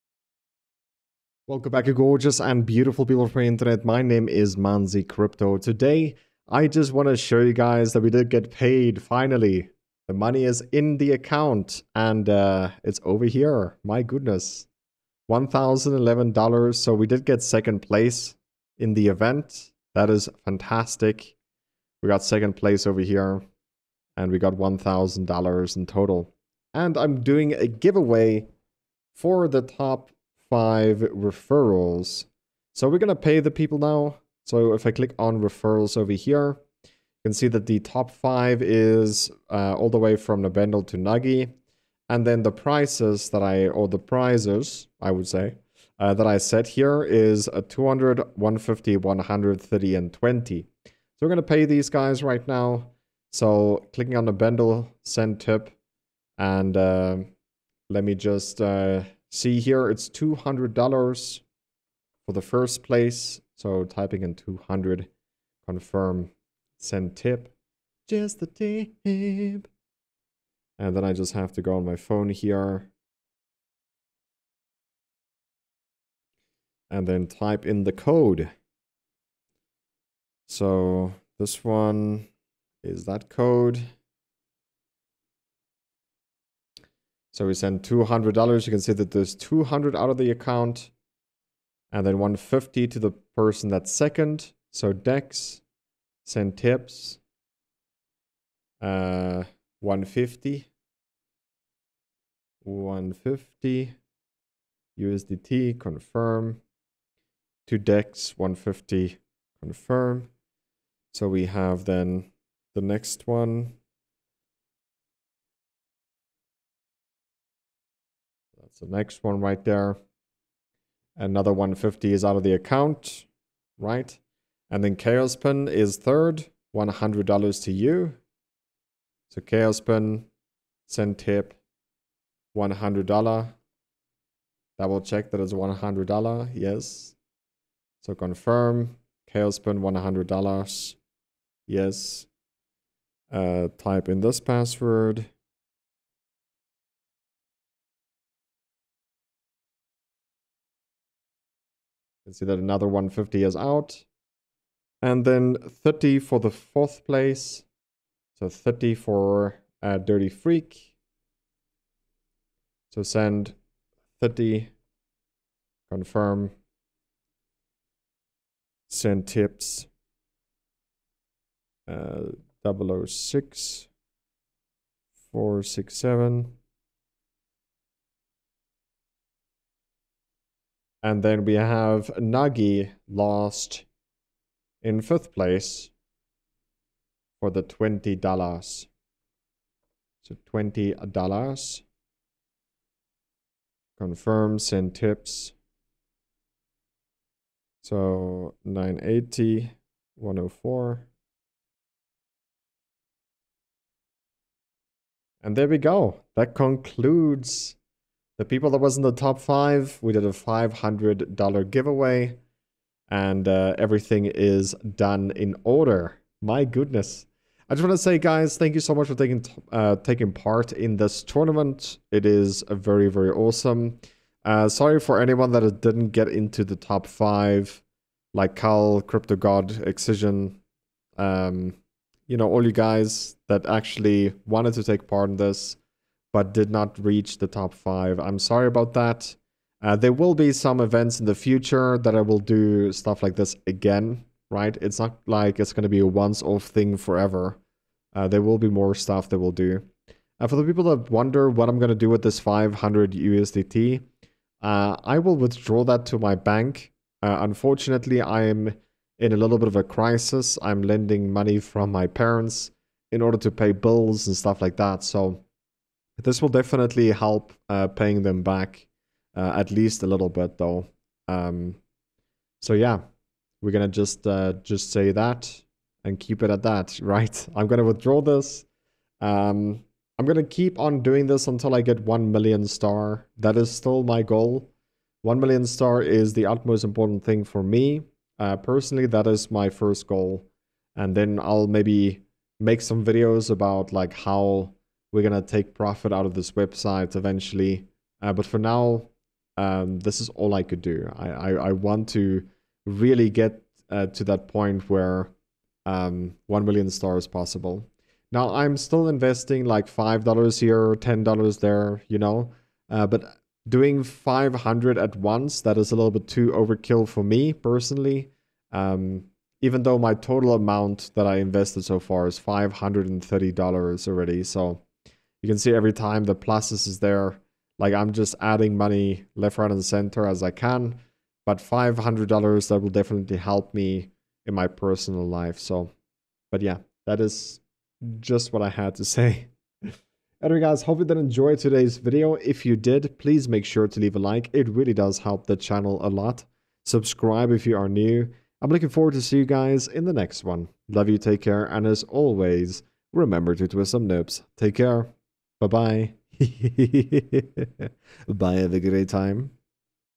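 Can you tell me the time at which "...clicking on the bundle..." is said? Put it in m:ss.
0:53.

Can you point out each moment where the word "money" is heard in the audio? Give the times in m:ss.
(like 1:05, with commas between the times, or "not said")
0:10, 4:21, 5:28.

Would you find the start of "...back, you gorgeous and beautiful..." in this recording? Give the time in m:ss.
0:01.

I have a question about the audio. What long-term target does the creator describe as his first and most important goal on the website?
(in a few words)
1 million stars.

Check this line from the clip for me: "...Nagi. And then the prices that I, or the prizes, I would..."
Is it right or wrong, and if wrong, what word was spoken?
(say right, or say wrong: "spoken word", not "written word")
right.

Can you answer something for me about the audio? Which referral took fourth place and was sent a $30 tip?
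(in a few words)
Dirty Freak.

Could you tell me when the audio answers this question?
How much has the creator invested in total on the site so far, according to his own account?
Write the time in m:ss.
5:22.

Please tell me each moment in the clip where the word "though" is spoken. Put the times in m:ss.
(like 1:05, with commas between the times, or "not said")
4:30, 5:19.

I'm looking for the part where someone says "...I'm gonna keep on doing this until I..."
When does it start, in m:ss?
4:40.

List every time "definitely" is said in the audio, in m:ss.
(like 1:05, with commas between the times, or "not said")
4:26, 5:32.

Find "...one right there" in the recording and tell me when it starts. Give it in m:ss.
1:59.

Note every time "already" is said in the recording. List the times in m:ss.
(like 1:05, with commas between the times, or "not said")
5:24.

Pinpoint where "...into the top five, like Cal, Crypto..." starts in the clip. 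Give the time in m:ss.
3:46.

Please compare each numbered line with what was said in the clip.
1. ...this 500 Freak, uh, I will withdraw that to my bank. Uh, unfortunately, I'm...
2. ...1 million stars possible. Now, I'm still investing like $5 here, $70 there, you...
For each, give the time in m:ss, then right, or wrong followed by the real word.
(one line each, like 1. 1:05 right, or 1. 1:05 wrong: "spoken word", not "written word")
1. 4:12 wrong: "USDT", not "Freak"
2. 5:06 wrong: "10", not "70".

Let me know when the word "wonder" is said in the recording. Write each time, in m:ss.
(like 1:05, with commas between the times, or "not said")
4:11.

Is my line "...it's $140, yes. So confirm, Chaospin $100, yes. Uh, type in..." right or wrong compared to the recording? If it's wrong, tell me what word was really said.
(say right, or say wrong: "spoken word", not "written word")
wrong: "100", not "140".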